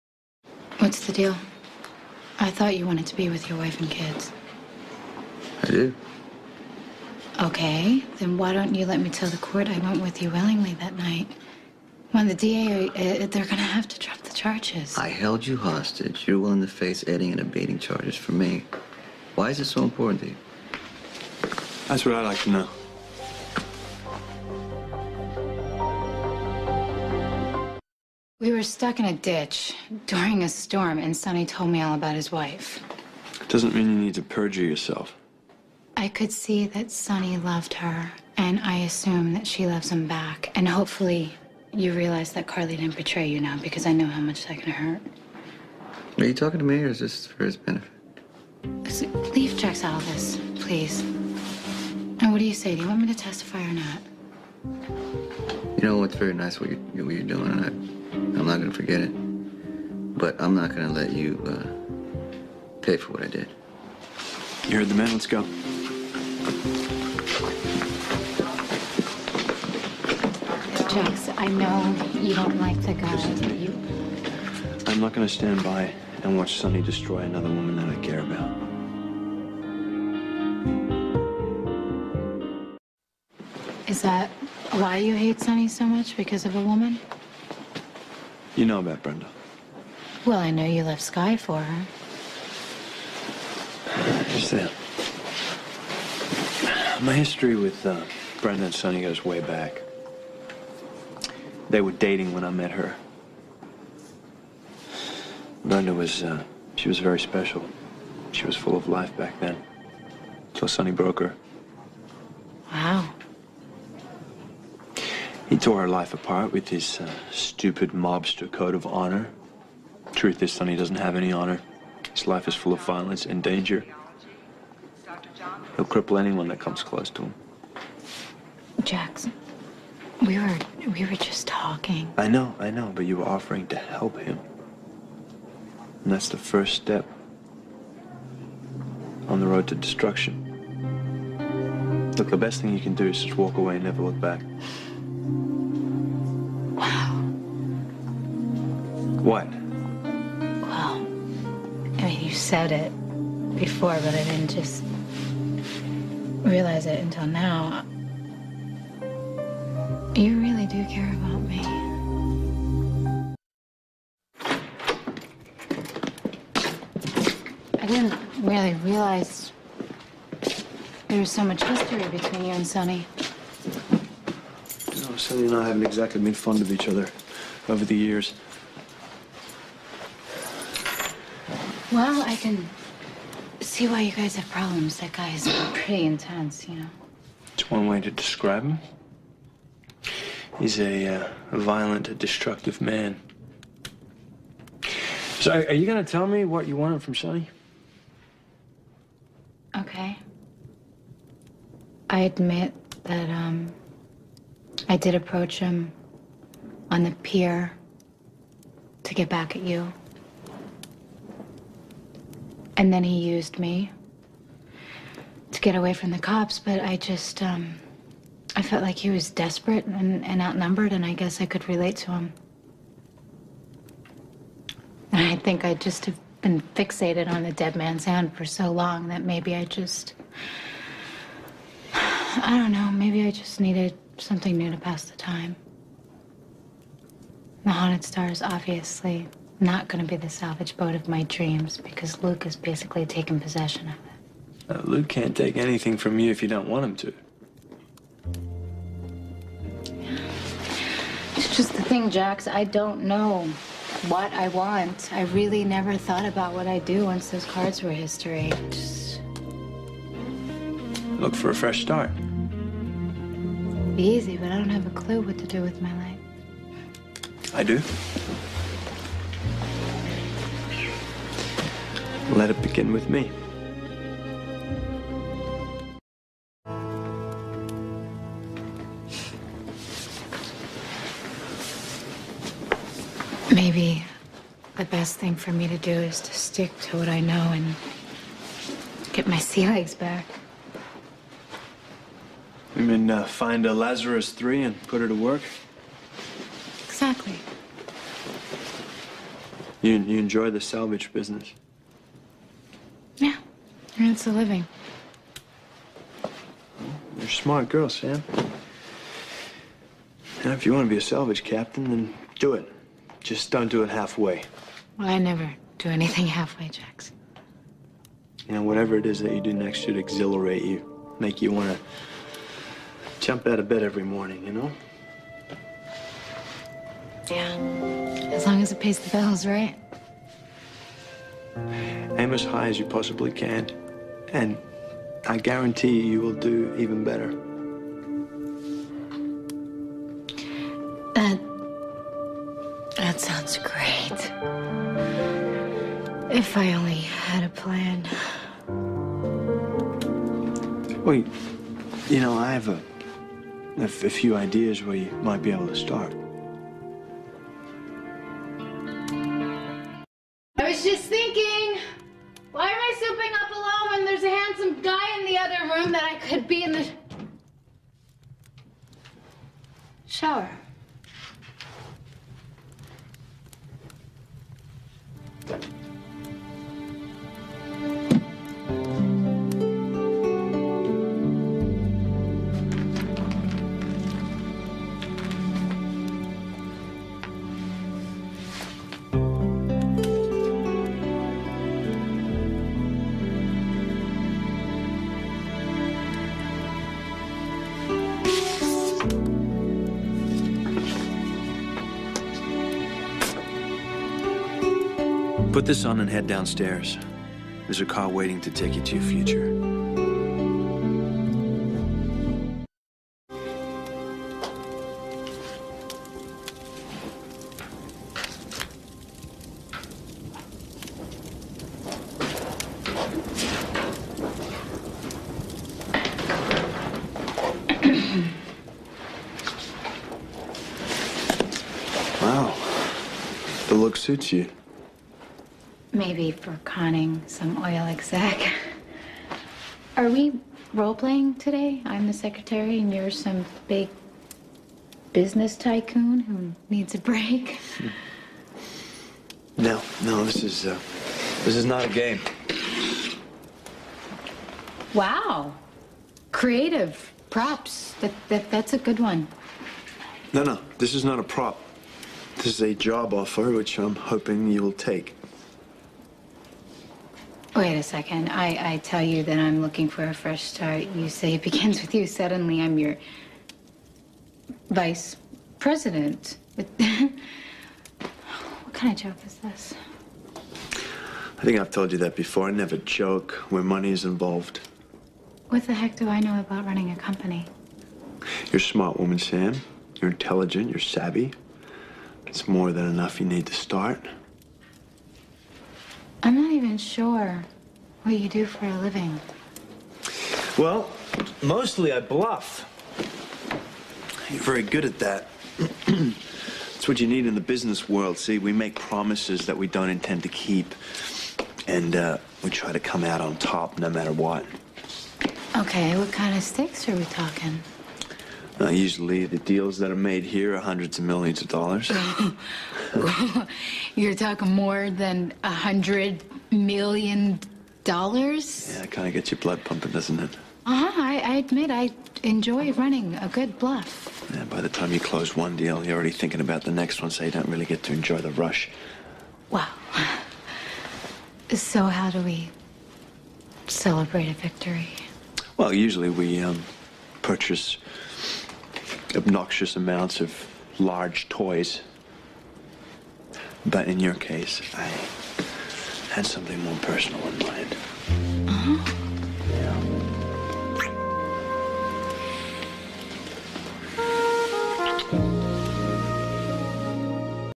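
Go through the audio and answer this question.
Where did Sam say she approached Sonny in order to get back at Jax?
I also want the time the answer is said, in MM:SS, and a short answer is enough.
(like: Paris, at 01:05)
The pier, at 03:27.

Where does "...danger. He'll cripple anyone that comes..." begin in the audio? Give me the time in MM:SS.
02:03.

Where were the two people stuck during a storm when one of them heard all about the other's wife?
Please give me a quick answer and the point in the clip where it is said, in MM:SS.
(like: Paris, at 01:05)
A ditch, at 00:29.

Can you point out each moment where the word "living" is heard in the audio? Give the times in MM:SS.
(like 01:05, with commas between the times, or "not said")
05:04, 08:18.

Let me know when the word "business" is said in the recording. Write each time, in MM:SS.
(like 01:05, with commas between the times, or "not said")
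05:01, 07:25, 08:27.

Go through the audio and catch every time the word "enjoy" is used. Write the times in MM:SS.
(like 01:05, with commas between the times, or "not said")
05:00, 08:52, 08:57.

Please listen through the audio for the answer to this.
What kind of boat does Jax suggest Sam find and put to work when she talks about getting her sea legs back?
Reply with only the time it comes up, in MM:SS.
04:53.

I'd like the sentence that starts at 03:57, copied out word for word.
The Haunted Stars, obviously, not going to be the salvage boat of my dreams because Luke has basically taken possession of it.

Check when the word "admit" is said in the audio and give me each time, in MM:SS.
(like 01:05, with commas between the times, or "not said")
03:22, 08:51.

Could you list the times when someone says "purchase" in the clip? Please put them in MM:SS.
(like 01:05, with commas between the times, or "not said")
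09:07.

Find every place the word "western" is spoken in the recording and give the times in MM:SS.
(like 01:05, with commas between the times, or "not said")
not said.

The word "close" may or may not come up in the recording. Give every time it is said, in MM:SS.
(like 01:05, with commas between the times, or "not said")
02:06, 08:54.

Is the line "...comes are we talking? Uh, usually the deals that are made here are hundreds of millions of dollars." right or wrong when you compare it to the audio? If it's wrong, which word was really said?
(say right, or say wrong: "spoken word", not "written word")
wrong: "stakes", not "comes".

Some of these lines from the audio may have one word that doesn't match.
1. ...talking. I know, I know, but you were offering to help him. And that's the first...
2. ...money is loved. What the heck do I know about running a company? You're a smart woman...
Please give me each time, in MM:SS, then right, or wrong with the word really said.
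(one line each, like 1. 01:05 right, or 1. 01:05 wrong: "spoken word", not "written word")
1. 02:11 right
2. 08:03 wrong: "involved", not "loved".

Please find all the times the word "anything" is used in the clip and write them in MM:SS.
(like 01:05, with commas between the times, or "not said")
04:05, 05:15.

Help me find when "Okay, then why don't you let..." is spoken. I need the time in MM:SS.
00:07.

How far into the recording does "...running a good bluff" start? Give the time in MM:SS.
08:52.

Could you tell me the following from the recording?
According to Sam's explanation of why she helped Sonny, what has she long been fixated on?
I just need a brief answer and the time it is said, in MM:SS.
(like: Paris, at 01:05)
The dead man's hand, at 03:47.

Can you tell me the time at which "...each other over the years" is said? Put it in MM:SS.
02:56.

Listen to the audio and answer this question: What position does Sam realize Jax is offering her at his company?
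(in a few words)
Vice president.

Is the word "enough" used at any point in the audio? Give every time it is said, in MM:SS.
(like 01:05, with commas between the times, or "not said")
08:12.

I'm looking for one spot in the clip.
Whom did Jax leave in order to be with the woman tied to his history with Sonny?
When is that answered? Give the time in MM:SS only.
01:31.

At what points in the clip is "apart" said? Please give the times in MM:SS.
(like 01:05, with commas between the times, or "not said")
01:56.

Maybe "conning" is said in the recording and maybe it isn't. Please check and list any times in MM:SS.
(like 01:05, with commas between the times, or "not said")
07:16.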